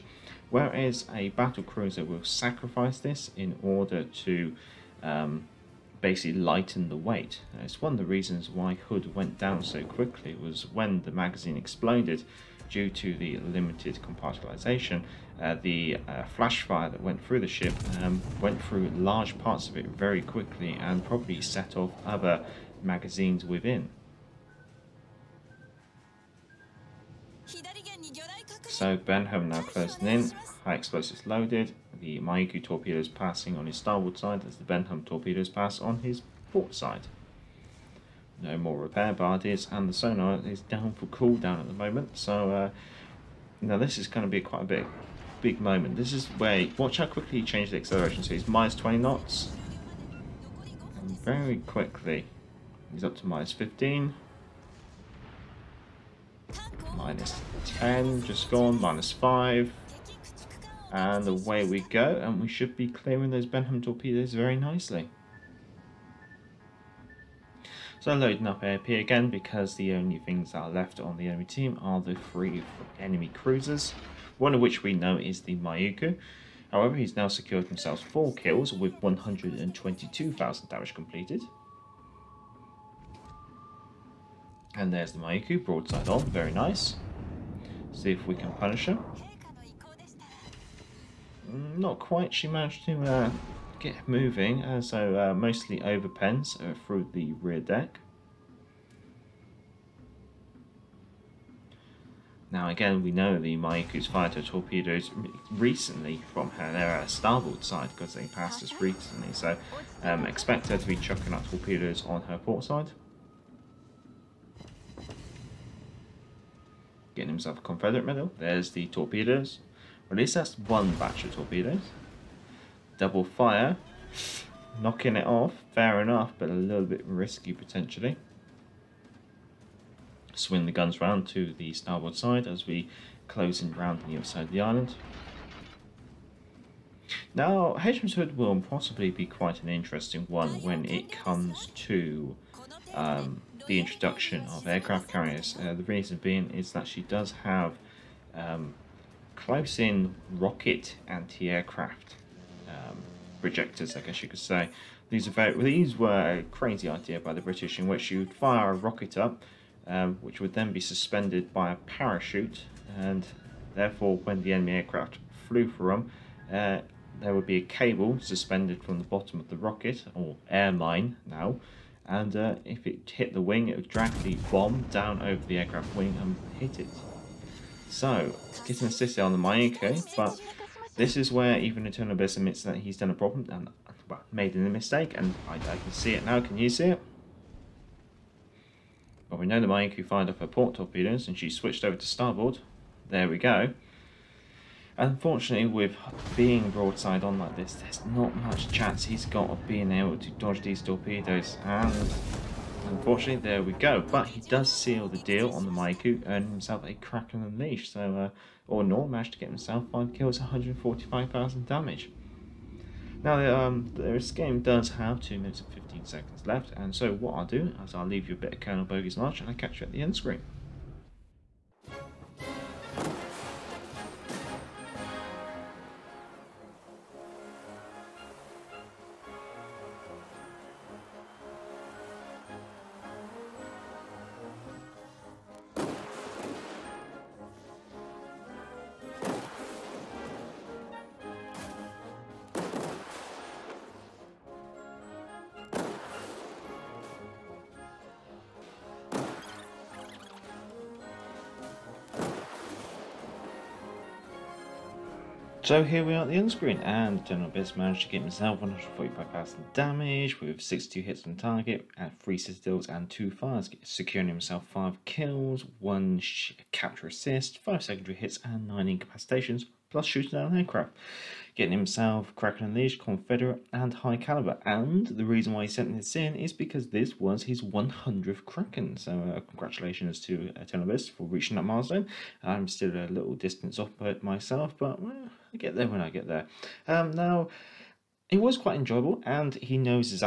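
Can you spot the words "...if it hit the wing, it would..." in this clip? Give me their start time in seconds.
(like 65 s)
172 s.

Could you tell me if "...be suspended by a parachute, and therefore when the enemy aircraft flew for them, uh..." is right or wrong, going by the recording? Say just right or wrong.
right.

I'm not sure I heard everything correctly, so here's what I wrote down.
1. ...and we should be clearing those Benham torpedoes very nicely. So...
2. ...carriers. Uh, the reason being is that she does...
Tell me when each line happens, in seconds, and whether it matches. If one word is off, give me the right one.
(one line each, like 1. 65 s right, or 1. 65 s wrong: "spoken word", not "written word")
1. 62 s right
2. 145 s right.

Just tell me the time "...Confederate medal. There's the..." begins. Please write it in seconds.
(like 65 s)
117 s.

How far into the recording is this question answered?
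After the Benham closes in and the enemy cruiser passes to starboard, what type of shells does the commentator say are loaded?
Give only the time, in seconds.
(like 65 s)
30 s.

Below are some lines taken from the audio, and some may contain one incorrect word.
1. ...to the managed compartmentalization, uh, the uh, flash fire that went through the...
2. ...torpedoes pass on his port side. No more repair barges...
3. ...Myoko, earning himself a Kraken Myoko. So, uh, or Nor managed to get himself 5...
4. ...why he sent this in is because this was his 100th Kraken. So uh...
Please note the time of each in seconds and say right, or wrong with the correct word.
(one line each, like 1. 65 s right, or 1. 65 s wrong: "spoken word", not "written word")
1. 12 s wrong: "limited", not "managed"
2. 35 s right
3. 205 s wrong: "Unleashed", not "Myoko"
4. 275 s right.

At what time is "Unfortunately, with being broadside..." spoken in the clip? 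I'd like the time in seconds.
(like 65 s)
194 s.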